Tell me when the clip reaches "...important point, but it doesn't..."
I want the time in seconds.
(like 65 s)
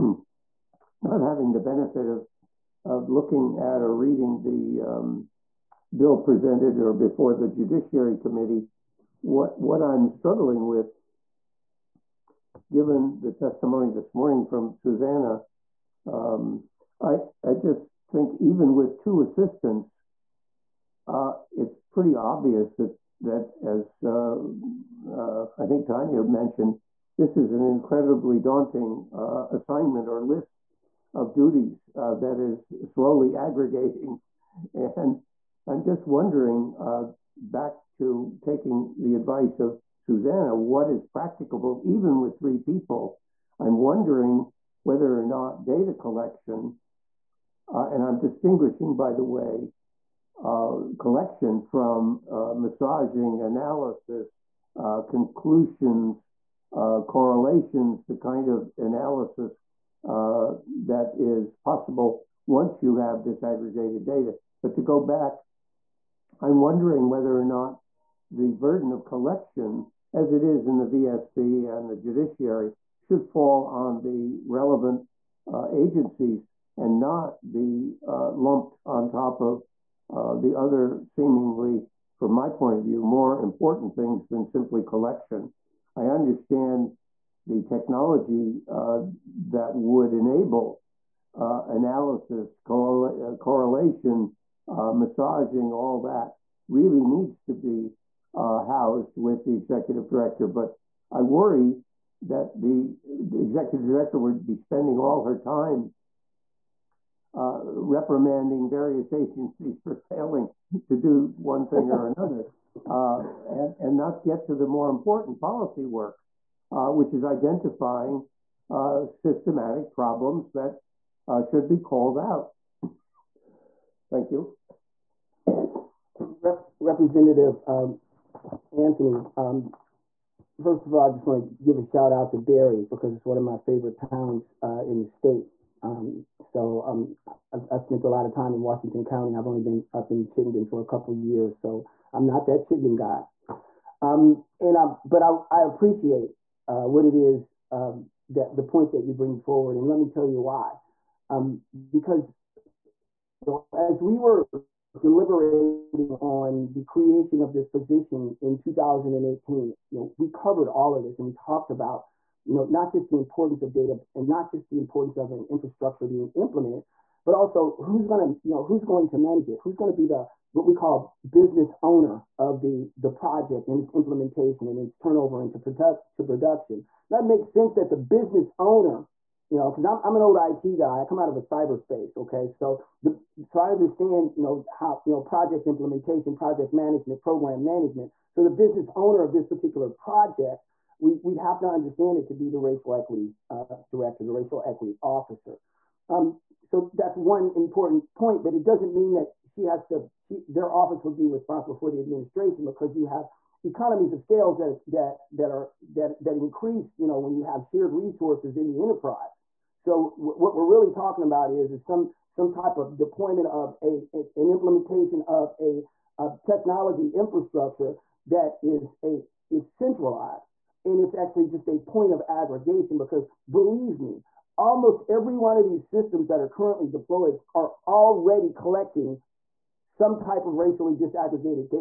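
197 s.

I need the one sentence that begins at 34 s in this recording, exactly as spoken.
And I'm just wondering, uh, back to taking the advice of Xusana, what is practicable even with three people?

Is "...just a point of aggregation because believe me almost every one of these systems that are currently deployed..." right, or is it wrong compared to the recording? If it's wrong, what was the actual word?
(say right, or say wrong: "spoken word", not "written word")
right.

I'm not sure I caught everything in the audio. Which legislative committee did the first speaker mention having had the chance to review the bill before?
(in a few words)
Judiciary Committee.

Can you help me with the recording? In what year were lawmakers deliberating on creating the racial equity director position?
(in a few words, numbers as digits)
2018.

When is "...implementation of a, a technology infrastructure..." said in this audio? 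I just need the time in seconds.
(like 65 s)
214 s.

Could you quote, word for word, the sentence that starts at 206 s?
You know, when you have shared resources in the enterprise.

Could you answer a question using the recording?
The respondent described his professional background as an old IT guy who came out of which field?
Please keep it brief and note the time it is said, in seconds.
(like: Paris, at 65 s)
cyberspace, at 181 s.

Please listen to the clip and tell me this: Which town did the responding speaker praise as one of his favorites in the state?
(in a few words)
Barre.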